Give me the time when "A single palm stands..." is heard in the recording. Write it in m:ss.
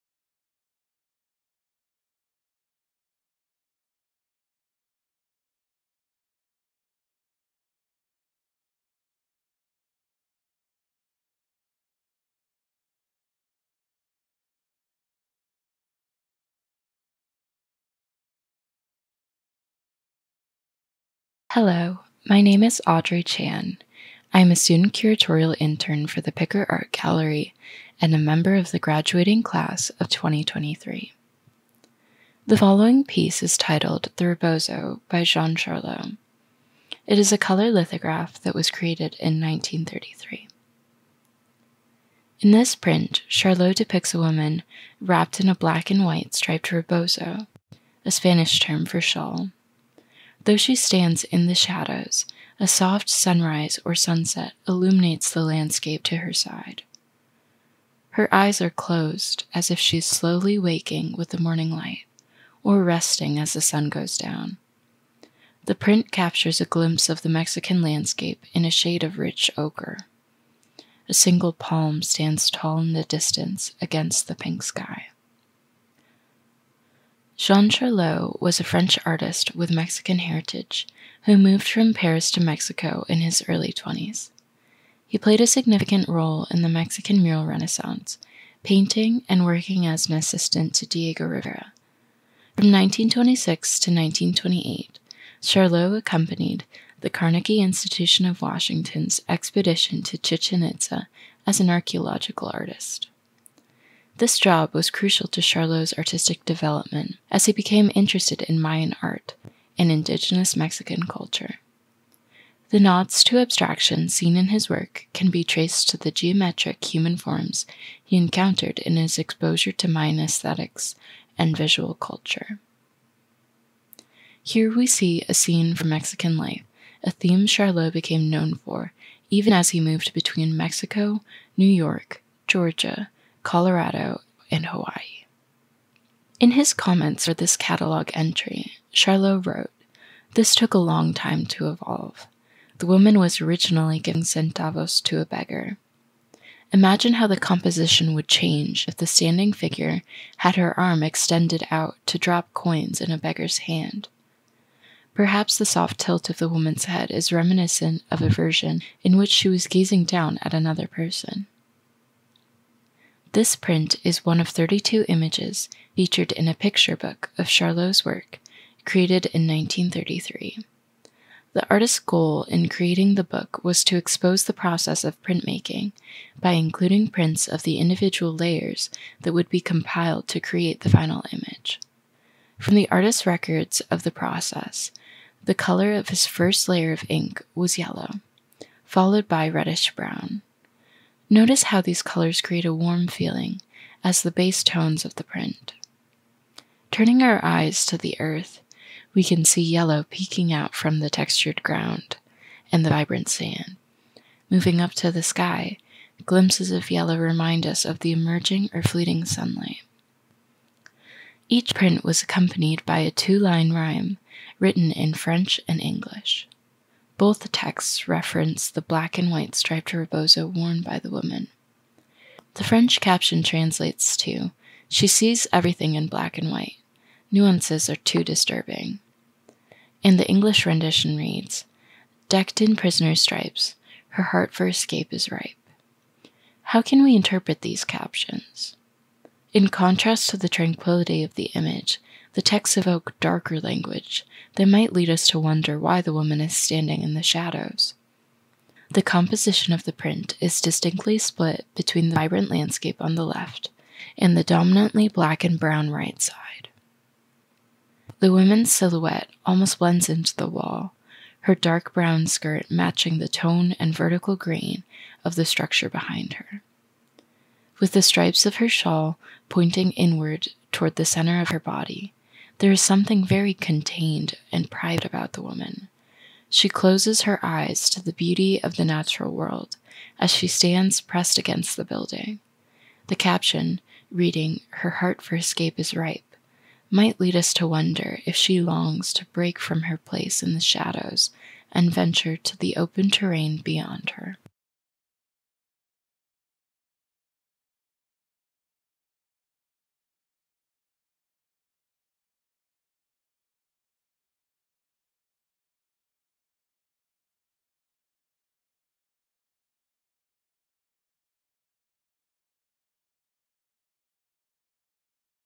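1:11.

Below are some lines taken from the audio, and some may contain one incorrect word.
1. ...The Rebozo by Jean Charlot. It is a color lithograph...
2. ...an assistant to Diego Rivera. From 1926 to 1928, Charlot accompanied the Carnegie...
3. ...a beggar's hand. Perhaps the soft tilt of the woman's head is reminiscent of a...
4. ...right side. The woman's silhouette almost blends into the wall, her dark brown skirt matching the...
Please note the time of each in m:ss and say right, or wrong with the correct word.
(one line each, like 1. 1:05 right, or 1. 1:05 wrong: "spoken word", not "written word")
1. 0:34 right
2. 1:30 right
3. 2:33 right
4. 4:15 right.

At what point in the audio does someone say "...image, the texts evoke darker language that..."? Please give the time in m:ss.
4:01.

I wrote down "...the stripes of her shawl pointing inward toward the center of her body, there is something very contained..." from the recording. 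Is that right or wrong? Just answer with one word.
right.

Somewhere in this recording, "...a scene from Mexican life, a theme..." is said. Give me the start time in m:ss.
2:05.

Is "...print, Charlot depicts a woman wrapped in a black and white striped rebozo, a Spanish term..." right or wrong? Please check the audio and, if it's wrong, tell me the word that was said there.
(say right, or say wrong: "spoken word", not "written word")
right.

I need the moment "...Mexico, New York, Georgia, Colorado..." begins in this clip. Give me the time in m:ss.
2:10.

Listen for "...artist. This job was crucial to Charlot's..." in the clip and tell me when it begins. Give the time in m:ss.
1:42.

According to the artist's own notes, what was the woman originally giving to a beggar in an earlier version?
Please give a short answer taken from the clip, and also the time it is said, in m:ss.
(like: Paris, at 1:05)
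centavos, at 2:24.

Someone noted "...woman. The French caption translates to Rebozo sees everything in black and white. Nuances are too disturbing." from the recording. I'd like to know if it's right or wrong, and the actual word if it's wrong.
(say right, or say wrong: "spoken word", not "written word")
wrong: "She", not "Rebozo".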